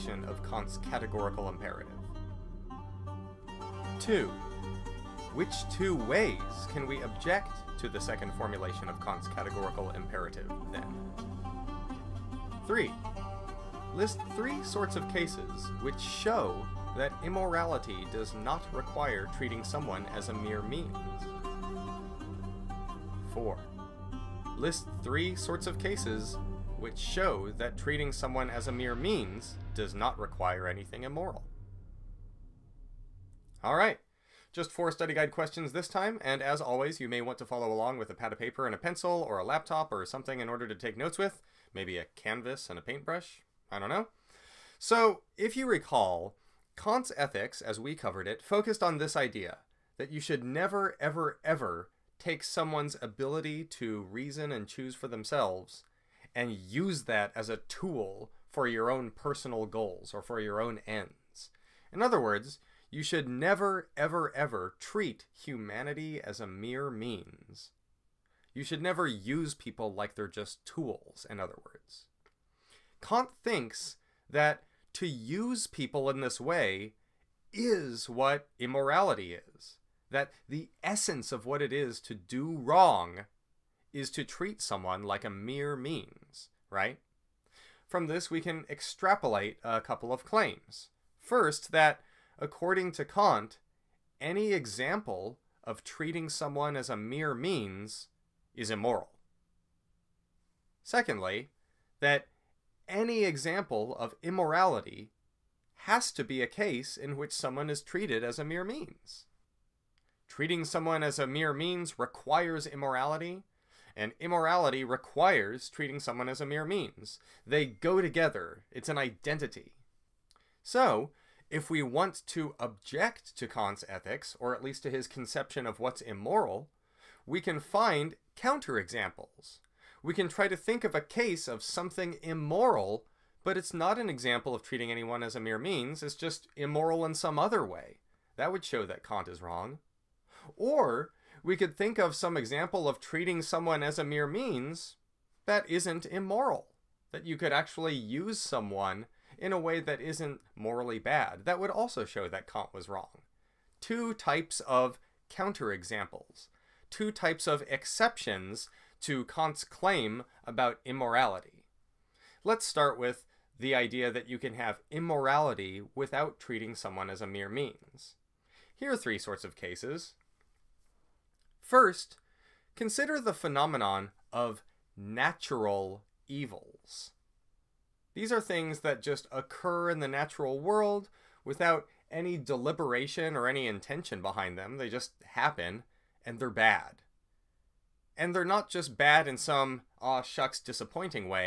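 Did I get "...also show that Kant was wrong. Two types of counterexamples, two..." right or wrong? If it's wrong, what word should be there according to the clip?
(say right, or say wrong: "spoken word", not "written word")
right.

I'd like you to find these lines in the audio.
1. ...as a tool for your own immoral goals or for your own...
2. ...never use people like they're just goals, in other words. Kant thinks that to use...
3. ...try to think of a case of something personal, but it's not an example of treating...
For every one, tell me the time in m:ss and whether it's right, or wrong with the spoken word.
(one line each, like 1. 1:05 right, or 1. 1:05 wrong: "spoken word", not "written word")
1. 0:57 wrong: "personal", not "immoral"
2. 1:08 wrong: "tools", not "goals"
3. 2:10 wrong: "immoral", not "personal".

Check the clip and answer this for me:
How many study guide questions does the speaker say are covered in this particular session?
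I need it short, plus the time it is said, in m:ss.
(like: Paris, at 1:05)
4, at 0:34.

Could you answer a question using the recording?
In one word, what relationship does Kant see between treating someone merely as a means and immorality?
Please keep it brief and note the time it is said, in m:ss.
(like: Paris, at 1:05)
an identity, at 1:58.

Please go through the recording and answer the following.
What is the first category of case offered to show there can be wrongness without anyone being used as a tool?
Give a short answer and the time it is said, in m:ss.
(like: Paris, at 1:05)
natural evils, at 2:54.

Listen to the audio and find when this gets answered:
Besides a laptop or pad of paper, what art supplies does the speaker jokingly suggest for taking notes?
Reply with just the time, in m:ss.
0:41.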